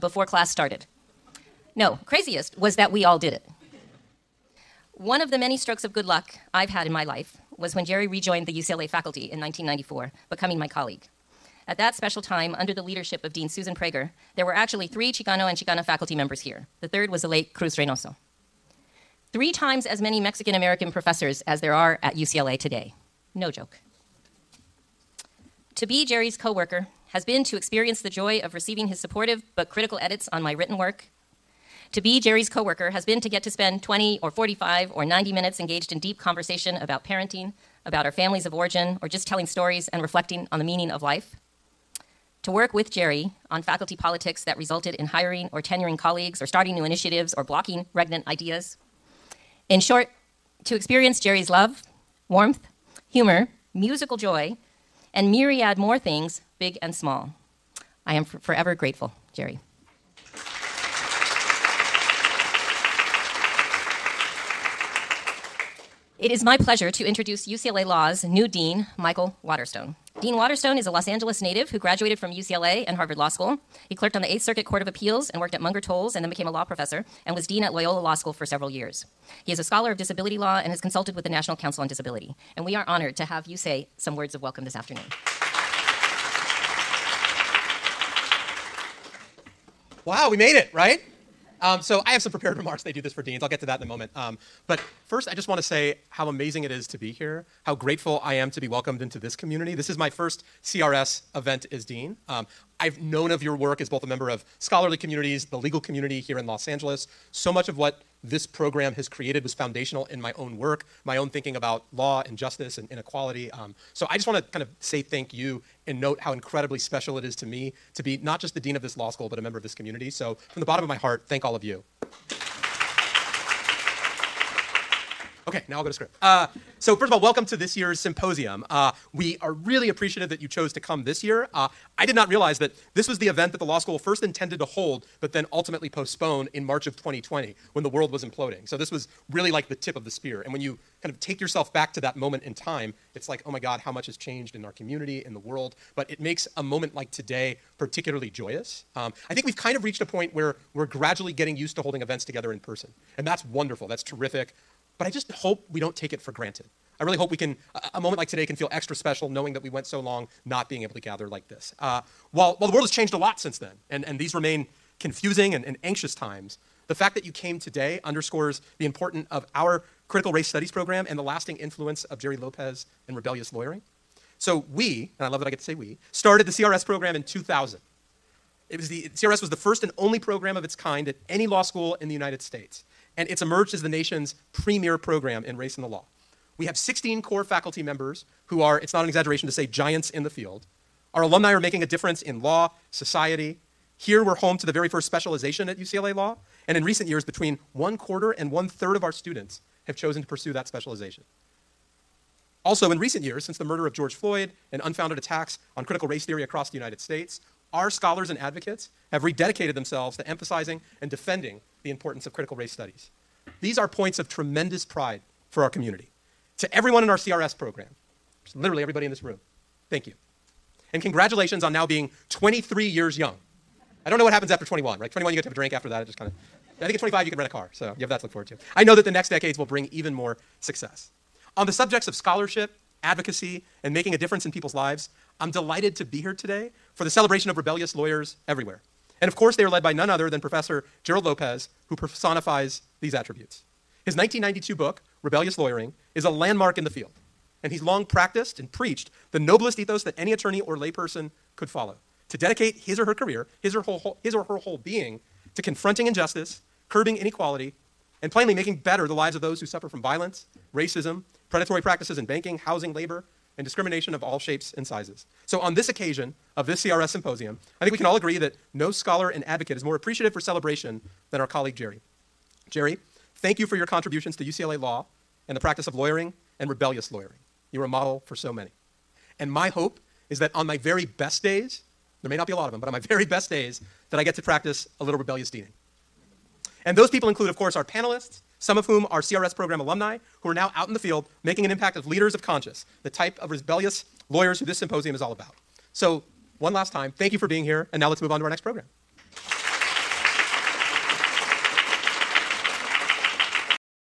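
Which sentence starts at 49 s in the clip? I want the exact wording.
In short, to experience Jerry's love, warmth, humor, musical joy, and myriad more things, big and small.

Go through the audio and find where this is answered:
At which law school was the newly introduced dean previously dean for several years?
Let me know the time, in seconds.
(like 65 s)
77 s.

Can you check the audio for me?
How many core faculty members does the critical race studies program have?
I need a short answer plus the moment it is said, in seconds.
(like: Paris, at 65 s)
16, at 186 s.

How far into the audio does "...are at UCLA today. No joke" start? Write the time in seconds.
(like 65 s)
21 s.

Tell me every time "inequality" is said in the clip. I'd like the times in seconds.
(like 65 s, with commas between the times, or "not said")
112 s, 257 s.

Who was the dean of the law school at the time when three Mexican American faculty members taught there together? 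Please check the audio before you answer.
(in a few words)
Susan Prager.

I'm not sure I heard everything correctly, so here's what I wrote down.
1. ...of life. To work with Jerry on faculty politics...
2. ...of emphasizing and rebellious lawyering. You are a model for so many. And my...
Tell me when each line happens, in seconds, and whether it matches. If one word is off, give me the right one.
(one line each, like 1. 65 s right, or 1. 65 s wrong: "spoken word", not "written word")
1. 40 s right
2. 275 s wrong: "lawyering", not "emphasizing".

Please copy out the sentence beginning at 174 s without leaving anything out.
So we, and I love that I get to say we, started the CRS program in 2000.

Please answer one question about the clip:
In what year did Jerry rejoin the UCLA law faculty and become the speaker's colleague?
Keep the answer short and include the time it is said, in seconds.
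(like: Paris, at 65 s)
1994, at 9 s.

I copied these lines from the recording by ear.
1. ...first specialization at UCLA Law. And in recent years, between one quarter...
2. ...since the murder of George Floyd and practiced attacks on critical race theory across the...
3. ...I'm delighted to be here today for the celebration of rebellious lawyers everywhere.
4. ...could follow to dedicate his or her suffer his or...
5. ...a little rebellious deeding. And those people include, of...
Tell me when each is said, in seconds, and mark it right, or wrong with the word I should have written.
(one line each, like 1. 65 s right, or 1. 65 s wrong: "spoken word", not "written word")
1. 194 s right
2. 203 s wrong: "unfounded", not "practiced"
3. 235 s right
4. 251 s wrong: "career", not "suffer"
5. 284 s right.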